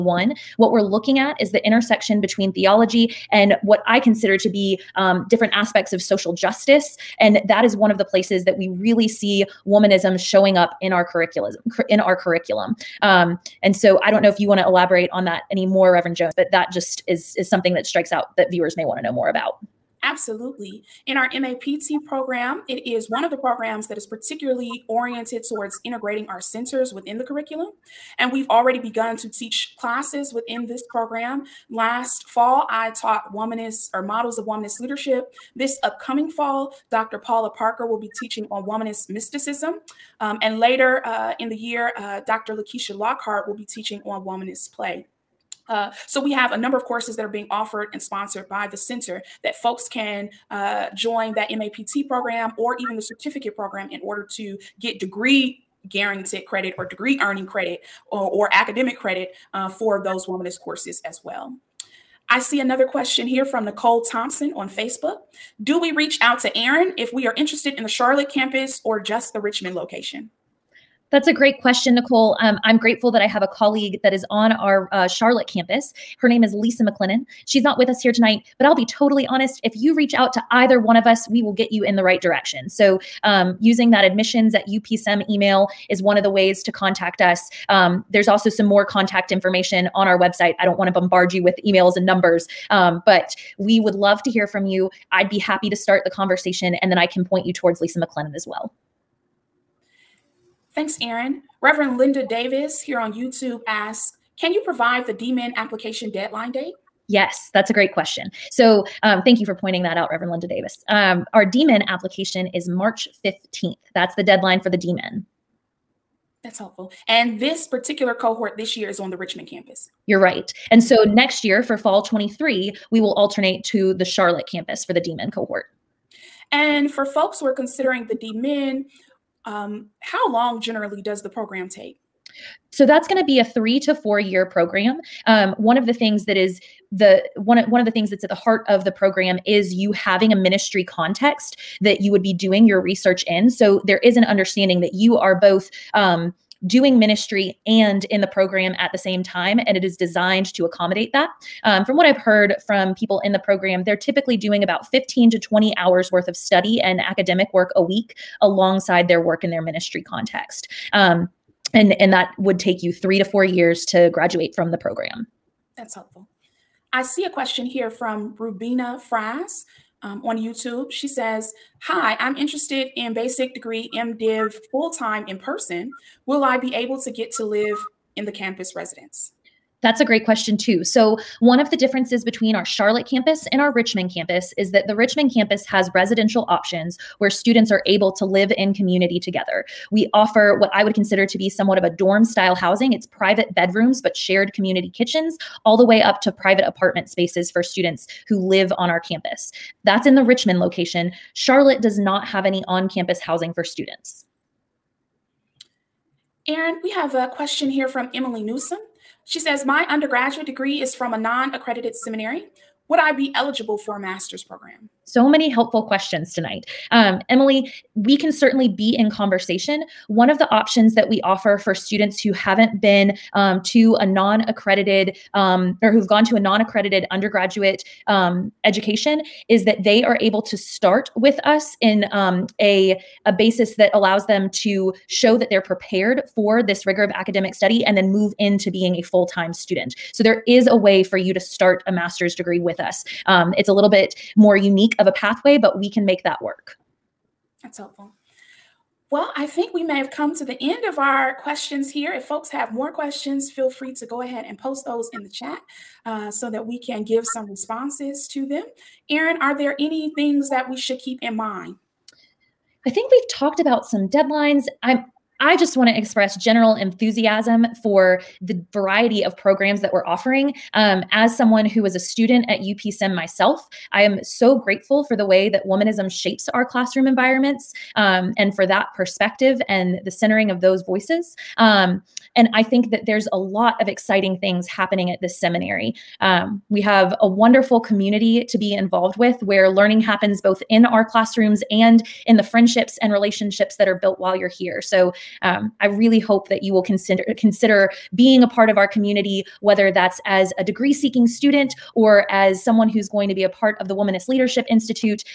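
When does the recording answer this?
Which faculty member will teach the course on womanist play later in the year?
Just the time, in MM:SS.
00:42.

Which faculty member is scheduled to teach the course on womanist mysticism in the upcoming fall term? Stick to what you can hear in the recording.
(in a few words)
Dr. Paula Parker.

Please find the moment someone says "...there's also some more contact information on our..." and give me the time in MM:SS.
01:28.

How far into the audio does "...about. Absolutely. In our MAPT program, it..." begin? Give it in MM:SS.
00:19.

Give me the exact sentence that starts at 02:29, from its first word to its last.
And it is designed to accommodate that.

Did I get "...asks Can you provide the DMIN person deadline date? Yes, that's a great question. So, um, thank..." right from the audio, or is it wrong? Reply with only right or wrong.
wrong.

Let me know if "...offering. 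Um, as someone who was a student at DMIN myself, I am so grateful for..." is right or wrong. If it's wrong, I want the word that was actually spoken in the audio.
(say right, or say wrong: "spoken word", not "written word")
wrong: "UPSem", not "DMIN".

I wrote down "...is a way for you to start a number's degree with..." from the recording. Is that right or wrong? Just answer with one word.
wrong.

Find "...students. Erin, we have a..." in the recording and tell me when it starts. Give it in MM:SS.
03:23.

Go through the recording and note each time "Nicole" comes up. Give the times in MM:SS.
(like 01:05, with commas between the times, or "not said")
01:03, 01:11.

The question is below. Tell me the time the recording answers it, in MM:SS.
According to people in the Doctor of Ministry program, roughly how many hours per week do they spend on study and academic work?
02:34.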